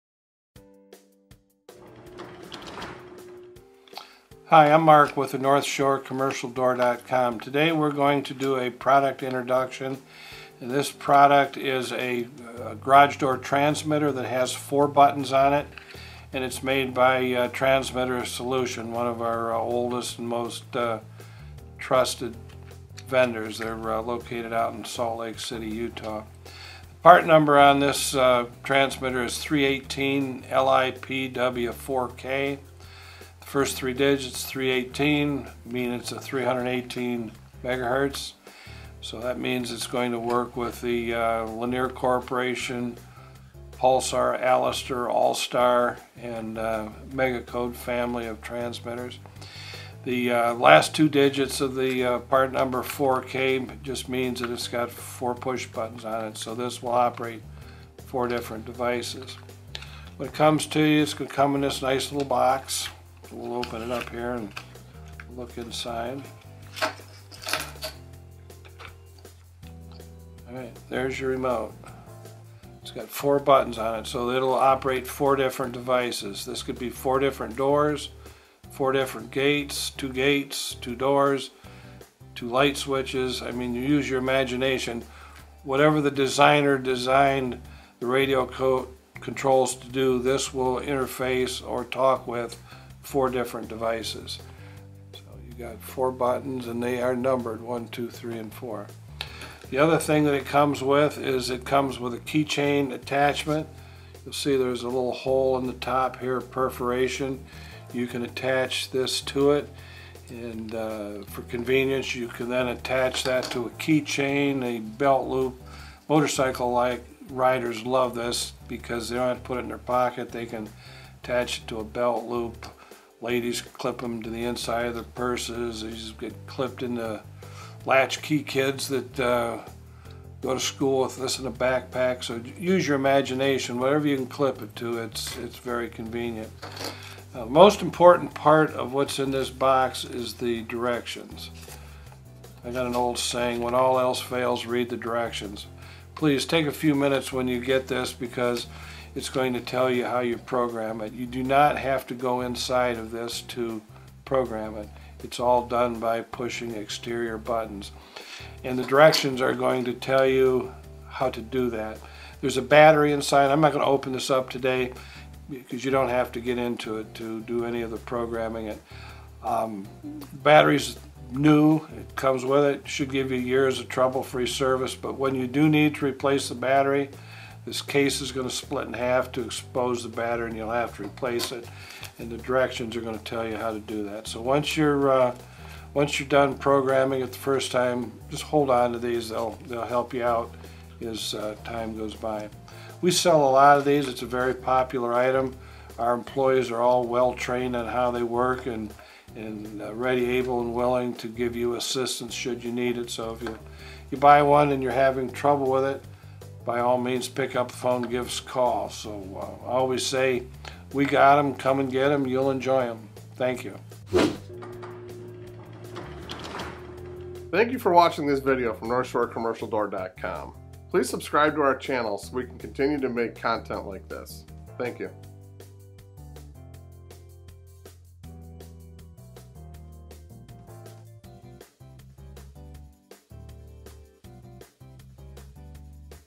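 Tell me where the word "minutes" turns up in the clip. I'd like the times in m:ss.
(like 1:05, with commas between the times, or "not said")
2:26.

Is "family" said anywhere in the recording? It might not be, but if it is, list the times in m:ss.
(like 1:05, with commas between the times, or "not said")
0:47.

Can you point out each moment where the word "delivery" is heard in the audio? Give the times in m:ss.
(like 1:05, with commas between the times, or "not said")
not said.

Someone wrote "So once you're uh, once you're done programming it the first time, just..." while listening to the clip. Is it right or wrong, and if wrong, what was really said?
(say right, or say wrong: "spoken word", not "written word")
right.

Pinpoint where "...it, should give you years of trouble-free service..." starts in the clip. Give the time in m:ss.
2:52.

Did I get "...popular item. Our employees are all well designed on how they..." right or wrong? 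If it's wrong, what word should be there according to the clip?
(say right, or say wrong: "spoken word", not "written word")
wrong: "trained", not "designed".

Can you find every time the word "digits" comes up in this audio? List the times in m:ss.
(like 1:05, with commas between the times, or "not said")
0:33, 0:51.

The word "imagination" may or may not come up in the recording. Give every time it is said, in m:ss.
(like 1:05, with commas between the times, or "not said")
1:24, 2:12.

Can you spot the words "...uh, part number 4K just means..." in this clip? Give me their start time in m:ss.
0:52.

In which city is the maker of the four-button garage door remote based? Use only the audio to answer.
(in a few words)
Salt Lake City.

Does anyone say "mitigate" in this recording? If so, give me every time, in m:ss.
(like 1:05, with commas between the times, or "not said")
not said.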